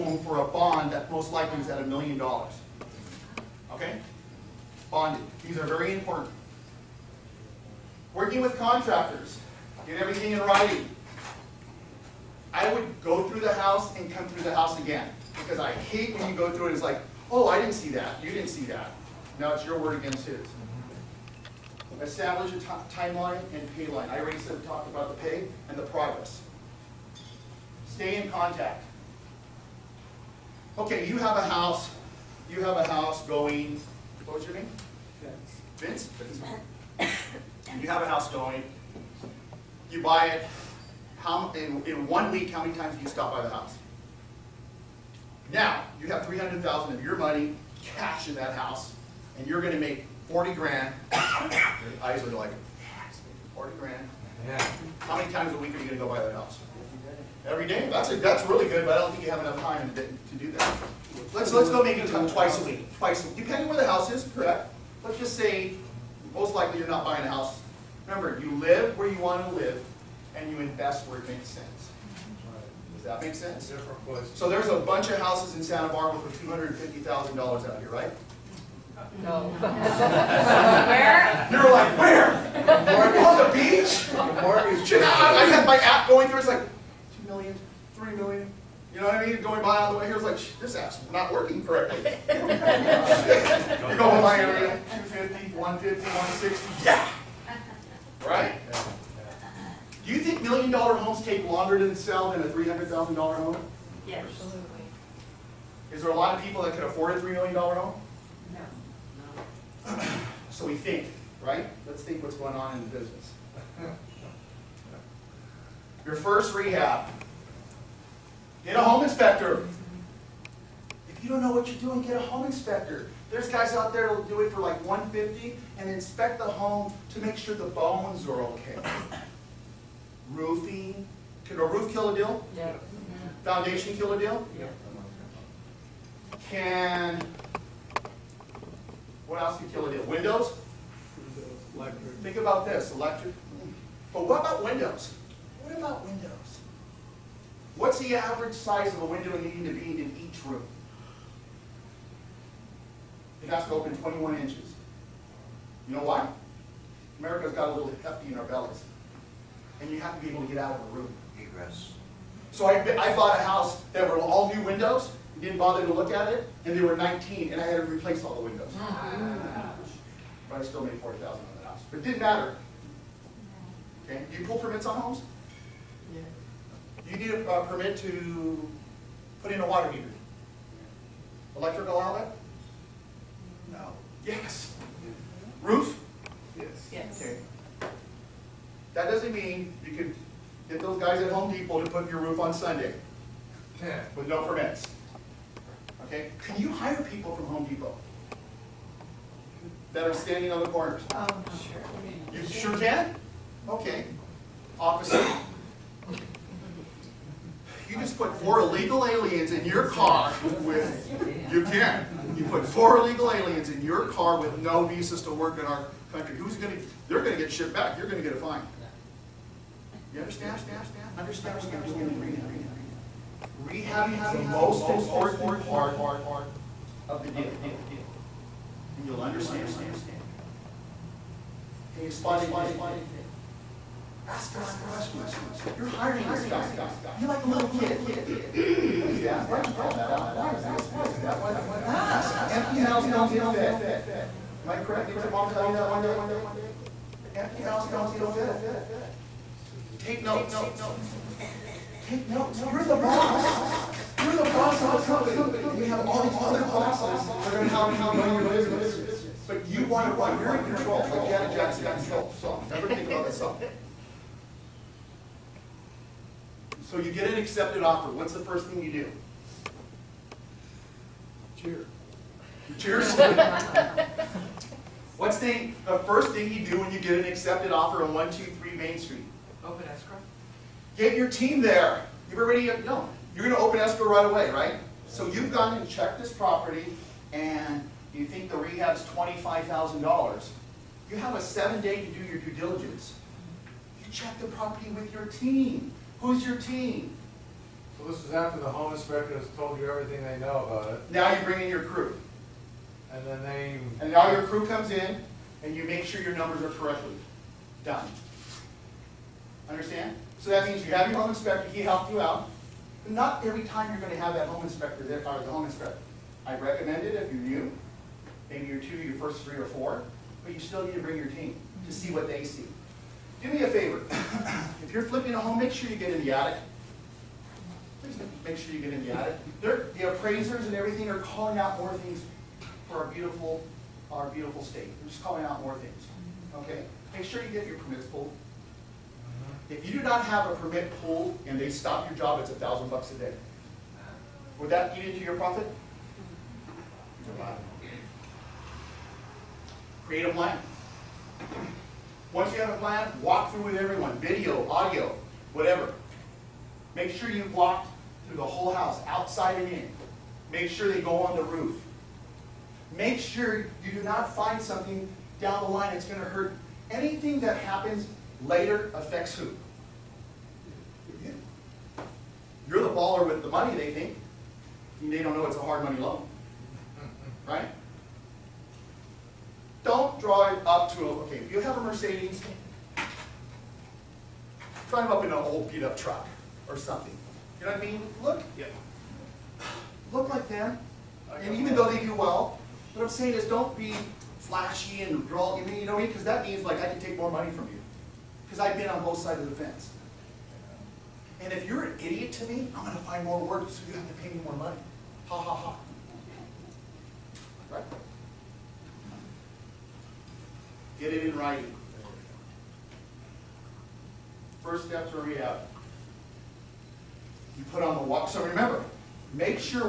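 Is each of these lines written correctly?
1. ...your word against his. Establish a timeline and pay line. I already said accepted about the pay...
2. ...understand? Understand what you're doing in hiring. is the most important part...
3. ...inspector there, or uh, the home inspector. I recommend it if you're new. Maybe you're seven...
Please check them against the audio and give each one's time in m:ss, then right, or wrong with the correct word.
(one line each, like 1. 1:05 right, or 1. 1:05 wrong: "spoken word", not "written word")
1. 0:19 wrong: "talked", not "accepted"
2. 3:40 wrong: "rehabbing", not "hiring"
3. 5:14 wrong: "two", not "seven".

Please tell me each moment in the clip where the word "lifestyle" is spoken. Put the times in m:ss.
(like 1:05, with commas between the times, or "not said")
not said.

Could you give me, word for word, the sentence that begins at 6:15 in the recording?
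they don't know it's a hard money loan.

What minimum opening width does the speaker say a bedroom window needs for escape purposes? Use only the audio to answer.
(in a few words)
21 inches.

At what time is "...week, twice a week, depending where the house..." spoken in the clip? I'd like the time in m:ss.
1:02.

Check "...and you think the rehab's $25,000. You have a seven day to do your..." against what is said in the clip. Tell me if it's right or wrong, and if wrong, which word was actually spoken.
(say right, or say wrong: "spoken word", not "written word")
right.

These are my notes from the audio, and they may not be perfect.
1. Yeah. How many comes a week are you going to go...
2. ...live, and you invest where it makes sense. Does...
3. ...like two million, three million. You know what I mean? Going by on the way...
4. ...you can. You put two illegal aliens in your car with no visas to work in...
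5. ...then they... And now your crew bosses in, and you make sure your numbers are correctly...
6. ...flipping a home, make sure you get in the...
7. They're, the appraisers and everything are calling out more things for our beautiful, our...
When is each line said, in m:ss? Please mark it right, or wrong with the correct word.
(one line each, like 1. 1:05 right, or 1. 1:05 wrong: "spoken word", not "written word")
1. 0:54 wrong: "times", not "comes"
2. 1:09 right
3. 1:26 right
4. 3:31 wrong: "four", not "two"
5. 5:03 wrong: "comes", not "bosses"
6. 5:25 right
7. 5:29 right.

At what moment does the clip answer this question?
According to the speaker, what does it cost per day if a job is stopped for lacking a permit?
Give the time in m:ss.
5:42.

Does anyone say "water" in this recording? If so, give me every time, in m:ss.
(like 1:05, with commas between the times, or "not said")
2:59.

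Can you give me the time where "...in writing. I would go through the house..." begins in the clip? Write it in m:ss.
0:10.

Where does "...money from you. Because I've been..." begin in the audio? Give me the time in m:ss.
6:37.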